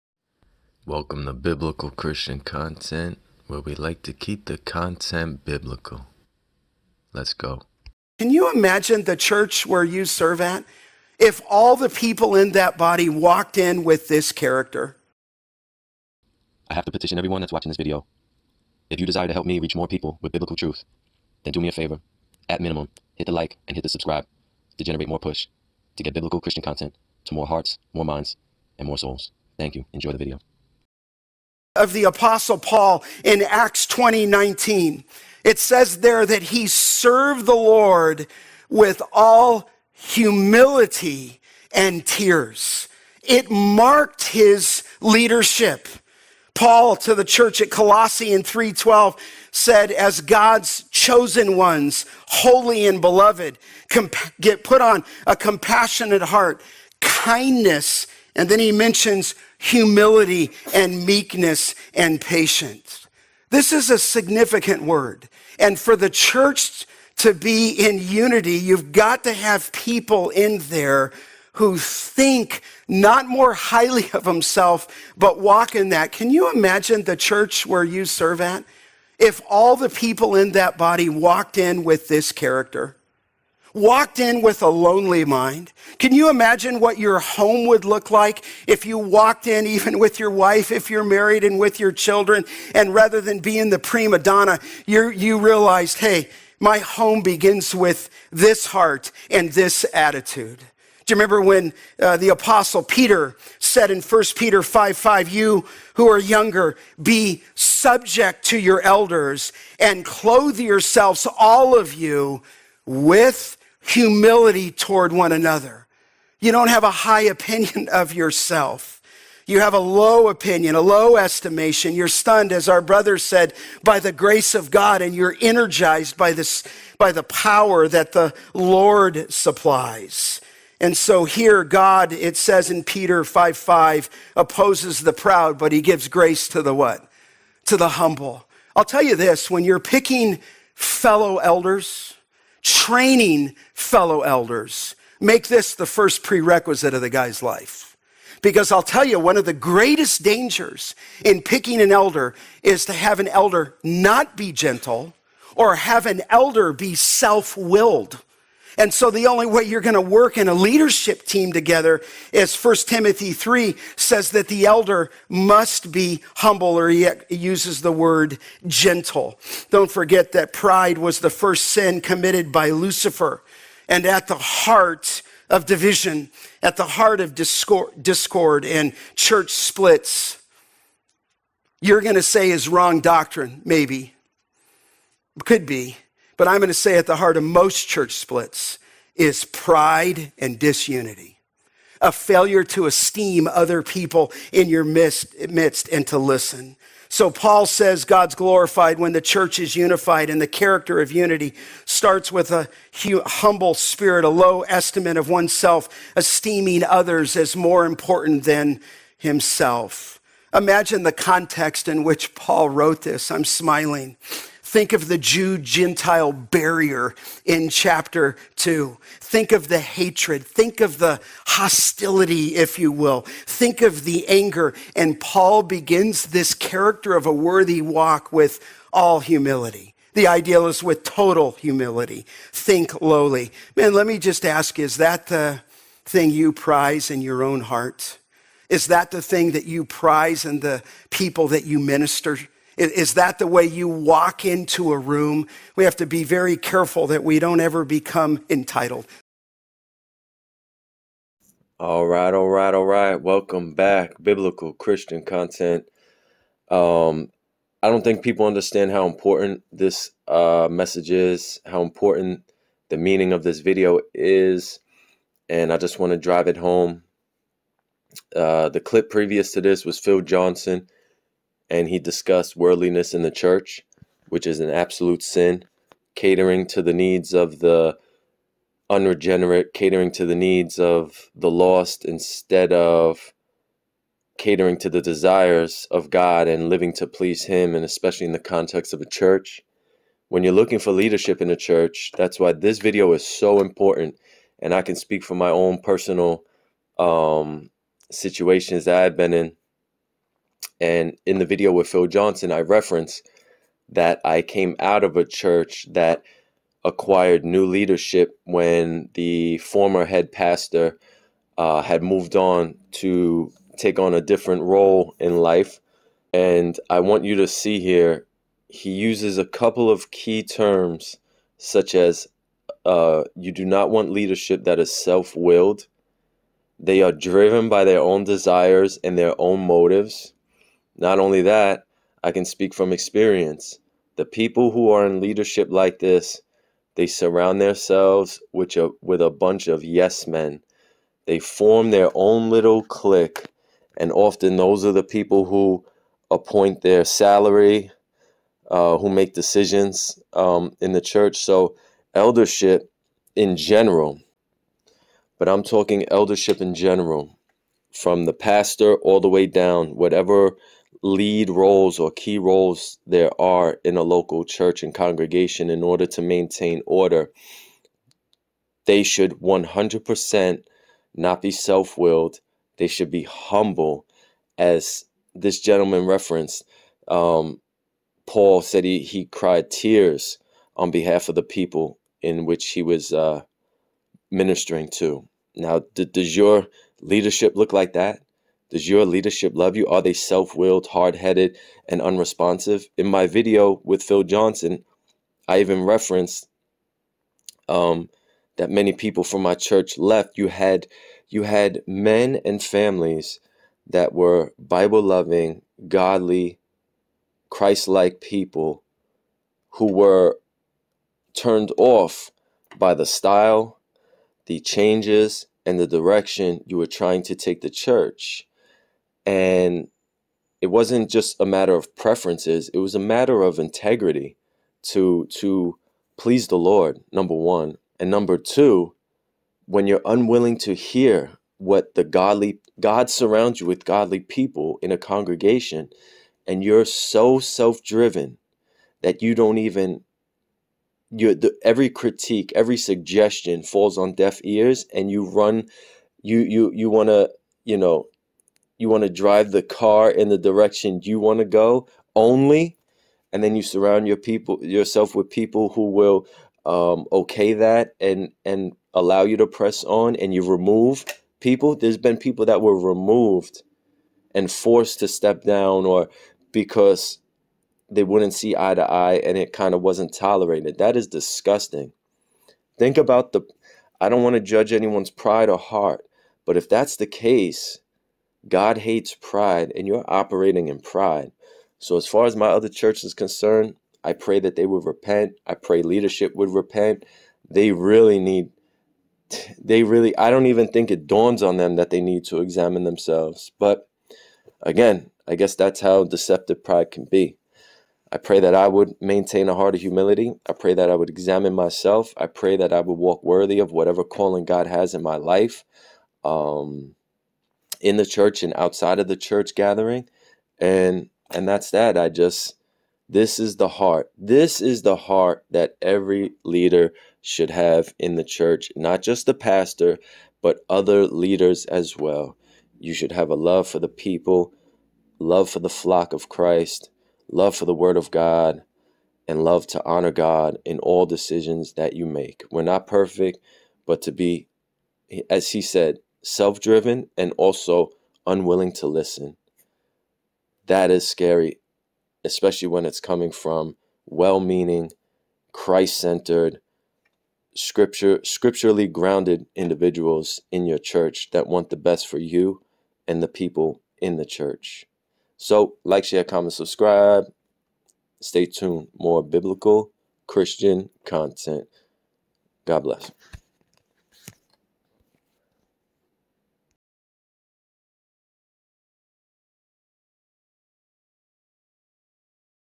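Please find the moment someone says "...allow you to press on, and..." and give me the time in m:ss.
7:38.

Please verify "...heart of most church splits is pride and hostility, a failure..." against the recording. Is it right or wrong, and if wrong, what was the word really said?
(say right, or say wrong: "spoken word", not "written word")
wrong: "disunity", not "hostility".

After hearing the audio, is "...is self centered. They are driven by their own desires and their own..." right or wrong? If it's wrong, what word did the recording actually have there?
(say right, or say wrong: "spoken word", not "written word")
wrong: "willed", not "centered".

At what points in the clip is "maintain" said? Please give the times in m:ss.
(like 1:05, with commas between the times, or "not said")
6:06, 8:18.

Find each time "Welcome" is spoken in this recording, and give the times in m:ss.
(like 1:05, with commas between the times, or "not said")
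0:00, 4:13.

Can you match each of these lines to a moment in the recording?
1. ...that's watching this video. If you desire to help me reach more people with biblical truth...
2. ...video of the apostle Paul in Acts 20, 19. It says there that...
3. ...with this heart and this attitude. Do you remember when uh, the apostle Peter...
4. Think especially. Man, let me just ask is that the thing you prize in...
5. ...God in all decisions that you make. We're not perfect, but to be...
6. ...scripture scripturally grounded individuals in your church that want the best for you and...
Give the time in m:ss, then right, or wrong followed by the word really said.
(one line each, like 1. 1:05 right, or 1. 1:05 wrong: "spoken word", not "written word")
1. 0:17 right
2. 0:30 right
3. 1:37 right
4. 3:52 wrong: "lowly", not "especially"
5. 8:50 right
6. 9:07 right.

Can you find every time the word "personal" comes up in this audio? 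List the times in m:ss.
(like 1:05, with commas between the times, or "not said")
4:55.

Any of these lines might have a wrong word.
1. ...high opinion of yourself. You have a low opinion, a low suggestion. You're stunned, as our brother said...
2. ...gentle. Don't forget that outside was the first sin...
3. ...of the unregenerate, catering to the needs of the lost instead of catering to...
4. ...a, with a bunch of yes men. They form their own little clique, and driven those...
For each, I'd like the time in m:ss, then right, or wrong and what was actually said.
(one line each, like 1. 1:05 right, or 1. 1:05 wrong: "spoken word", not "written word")
1. 1:56 wrong: "estimation", not "suggestion"
2. 2:48 wrong: "pride", not "outside"
3. 4:37 right
4. 5:38 wrong: "often", not "driven".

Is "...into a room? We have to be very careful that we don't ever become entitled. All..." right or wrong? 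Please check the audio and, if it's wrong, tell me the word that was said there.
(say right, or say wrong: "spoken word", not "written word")
right.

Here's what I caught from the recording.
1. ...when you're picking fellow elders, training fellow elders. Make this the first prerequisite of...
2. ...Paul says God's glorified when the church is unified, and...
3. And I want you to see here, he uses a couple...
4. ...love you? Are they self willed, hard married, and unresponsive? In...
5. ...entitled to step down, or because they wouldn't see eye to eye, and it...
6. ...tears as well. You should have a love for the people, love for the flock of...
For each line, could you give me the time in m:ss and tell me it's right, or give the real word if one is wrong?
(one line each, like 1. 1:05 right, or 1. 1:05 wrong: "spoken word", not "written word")
1. 2:19 right
2. 3:17 right
3. 5:16 right
4. 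6:29 wrong: "headed", not "married"
5. 7:44 wrong: "forced", not "entitled"
6. 8:41 wrong: "leaders", not "tears".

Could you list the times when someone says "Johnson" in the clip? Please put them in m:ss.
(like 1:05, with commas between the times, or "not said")
4:30, 5:02, 6:34.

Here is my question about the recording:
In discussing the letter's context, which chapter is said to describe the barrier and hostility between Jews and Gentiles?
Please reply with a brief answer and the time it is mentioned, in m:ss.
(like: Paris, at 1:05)
Chapter 2, at 3:37.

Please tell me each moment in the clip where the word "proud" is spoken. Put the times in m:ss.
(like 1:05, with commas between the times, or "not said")
2:15.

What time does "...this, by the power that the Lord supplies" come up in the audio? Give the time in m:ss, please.
2:06.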